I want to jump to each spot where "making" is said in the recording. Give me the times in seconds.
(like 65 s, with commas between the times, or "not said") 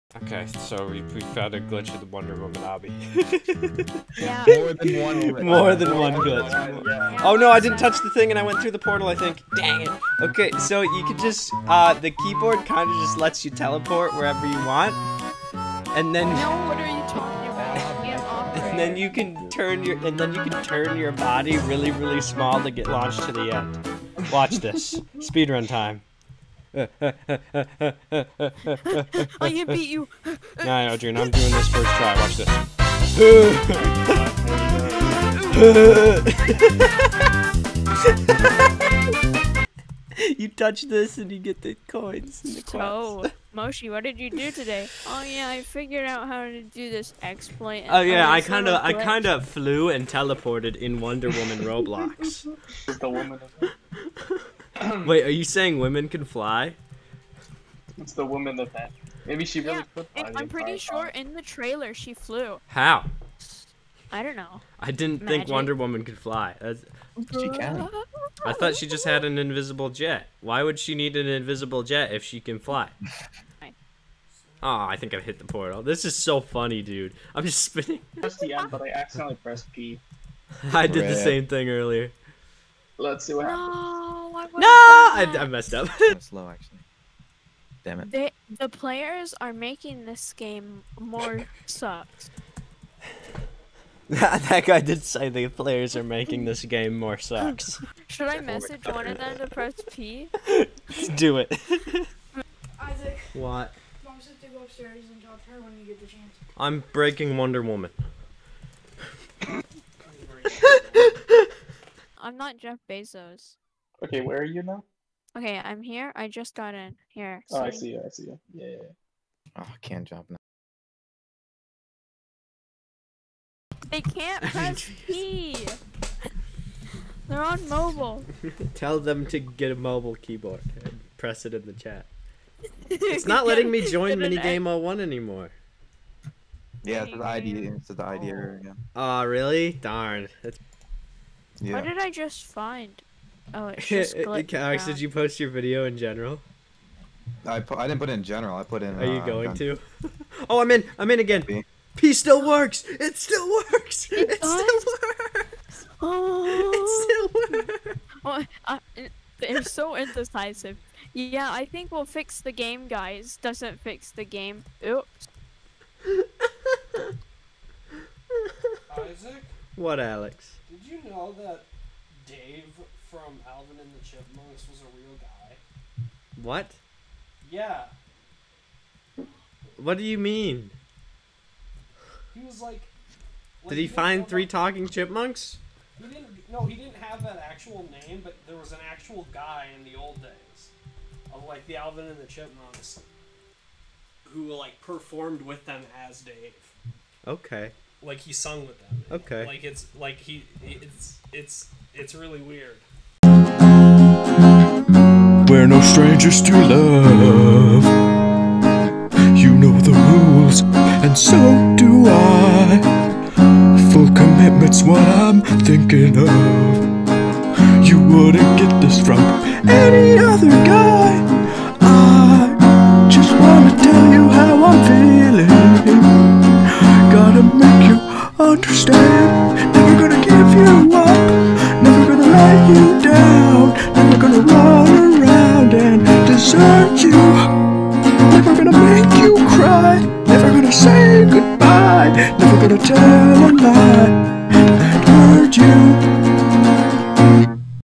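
89 s, 96 s.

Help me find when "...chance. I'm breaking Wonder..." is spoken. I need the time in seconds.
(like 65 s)
106 s.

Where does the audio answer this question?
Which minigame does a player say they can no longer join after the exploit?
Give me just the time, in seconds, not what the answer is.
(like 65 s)
134 s.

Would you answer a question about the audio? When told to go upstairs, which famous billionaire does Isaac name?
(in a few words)
Jeff Bezos.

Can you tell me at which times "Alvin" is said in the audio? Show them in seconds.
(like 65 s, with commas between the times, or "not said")
173 s, 191 s.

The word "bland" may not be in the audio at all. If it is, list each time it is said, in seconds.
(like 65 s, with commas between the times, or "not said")
not said.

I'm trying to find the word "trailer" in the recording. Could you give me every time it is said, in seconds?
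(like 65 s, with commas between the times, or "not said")
61 s.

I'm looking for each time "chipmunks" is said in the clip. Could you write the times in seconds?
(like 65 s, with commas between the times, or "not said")
174 s, 184 s, 192 s.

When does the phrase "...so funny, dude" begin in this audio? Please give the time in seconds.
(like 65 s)
76 s.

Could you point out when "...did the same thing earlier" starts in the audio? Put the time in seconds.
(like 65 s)
80 s.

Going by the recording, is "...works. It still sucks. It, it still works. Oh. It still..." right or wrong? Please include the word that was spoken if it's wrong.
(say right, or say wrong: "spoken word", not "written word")
wrong: "works", not "sucks".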